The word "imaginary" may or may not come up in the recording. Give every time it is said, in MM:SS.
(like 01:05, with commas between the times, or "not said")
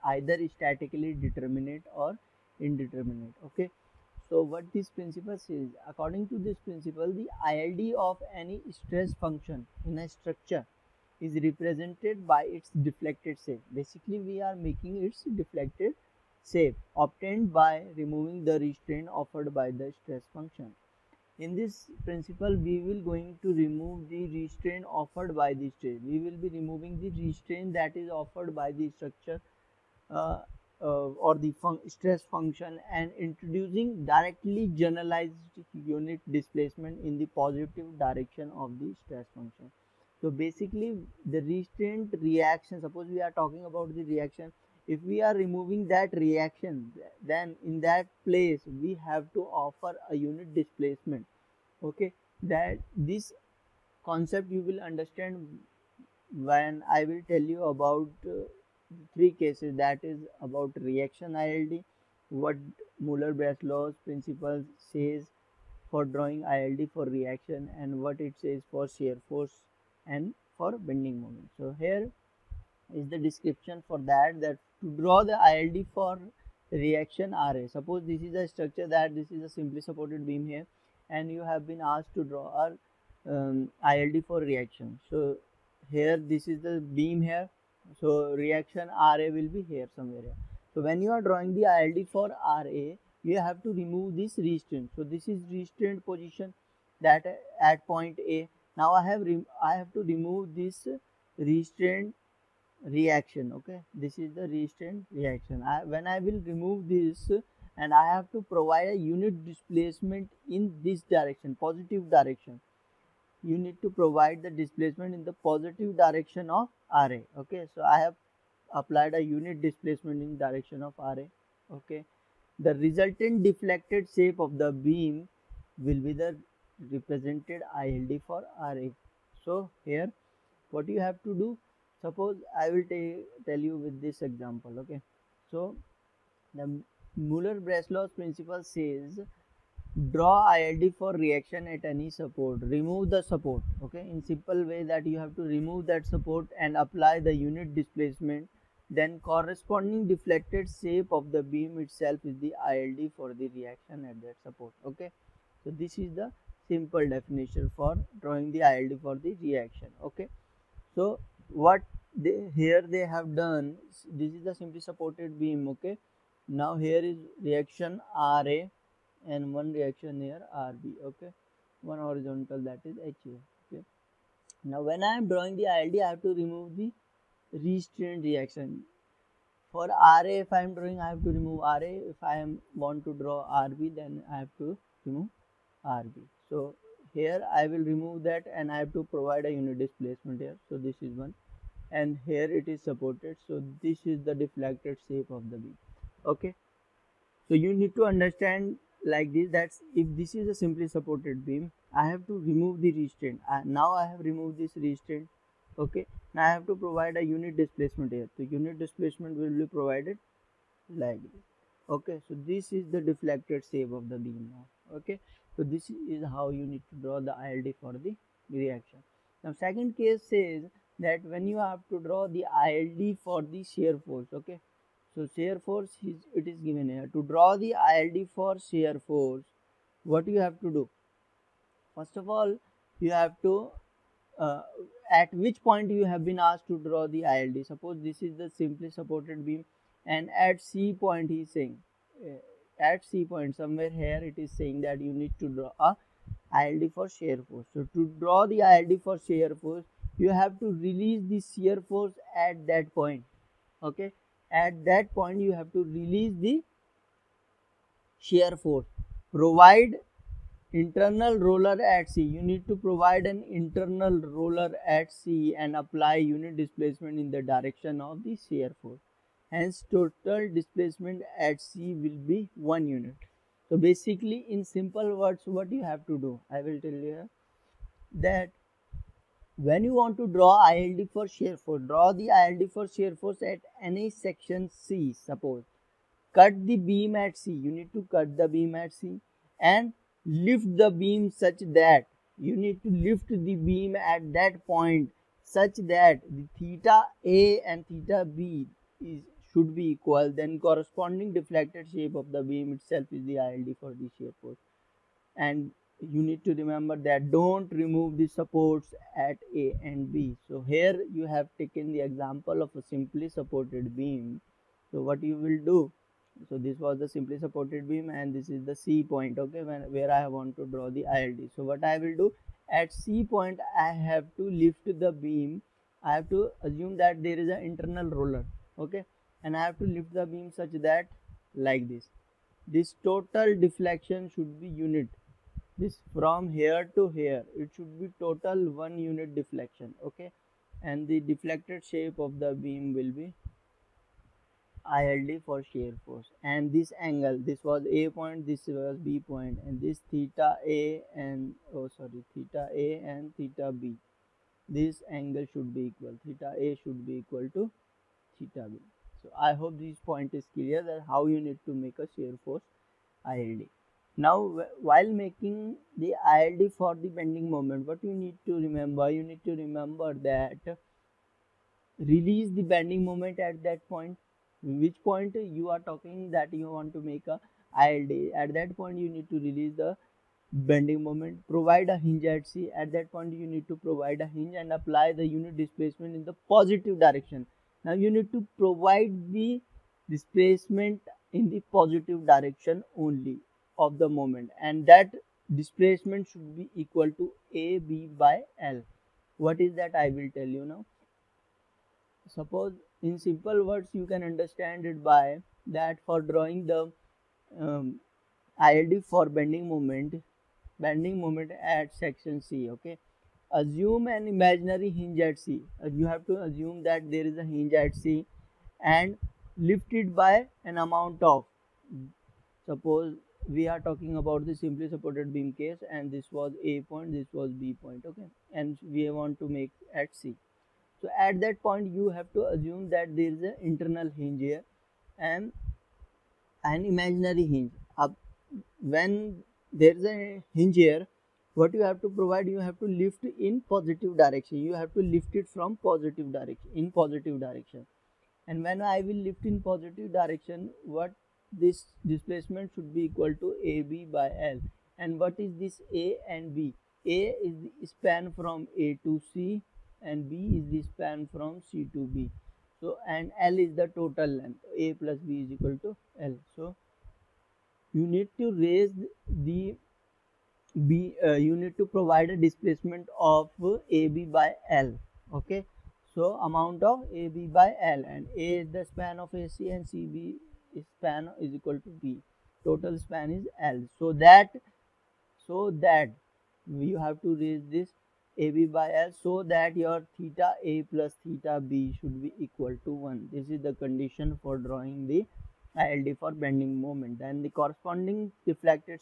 06:54, 07:16.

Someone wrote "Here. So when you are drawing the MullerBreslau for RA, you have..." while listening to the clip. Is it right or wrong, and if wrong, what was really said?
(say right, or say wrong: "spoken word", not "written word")
wrong: "ILD", not "MullerBreslau".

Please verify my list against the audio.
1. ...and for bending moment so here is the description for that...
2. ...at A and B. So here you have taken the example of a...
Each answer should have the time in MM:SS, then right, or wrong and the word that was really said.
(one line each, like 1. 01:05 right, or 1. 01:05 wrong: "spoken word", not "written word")
1. 01:10 right
2. 05:09 right.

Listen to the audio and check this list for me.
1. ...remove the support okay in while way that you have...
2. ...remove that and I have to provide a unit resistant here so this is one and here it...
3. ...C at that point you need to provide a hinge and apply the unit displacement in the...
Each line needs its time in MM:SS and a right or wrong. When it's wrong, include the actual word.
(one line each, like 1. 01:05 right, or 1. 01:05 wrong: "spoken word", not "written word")
1. 02:22 wrong: "simple", not "while"
2. 03:07 wrong: "displacement", not "resistant"
3. 06:22 right.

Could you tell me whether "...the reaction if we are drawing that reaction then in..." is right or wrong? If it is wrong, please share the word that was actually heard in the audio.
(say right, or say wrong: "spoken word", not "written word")
wrong: "removing", not "drawing".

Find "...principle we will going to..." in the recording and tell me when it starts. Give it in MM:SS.
00:22.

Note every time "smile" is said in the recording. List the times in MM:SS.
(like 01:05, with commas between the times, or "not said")
not said.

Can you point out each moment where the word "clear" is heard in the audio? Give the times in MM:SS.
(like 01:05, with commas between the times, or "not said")
06:00.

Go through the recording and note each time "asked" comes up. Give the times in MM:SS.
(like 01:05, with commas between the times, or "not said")
01:21, 03:56.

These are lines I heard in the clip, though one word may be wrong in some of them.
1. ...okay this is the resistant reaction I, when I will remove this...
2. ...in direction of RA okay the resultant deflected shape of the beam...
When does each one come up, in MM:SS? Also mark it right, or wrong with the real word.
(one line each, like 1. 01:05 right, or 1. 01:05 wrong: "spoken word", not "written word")
1. 01:43 right
2. 02:00 right.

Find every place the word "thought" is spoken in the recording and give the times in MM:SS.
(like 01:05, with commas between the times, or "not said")
not said.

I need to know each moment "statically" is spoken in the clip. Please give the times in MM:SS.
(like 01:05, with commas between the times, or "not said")
00:00.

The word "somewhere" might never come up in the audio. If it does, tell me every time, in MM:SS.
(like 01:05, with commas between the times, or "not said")
01:29, 04:03.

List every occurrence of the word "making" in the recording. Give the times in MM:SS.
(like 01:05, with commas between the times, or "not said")
00:14, 06:05.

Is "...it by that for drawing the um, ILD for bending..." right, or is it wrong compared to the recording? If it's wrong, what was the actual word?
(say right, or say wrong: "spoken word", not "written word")
right.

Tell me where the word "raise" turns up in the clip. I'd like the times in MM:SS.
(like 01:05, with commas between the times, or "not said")
07:48, 08:07.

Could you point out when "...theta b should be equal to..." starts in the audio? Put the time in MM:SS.
08:11.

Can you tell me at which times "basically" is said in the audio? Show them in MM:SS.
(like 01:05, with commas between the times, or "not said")
00:13, 00:40, 04:33.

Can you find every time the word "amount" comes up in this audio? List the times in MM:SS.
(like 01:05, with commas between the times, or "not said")
07:00, 07:56.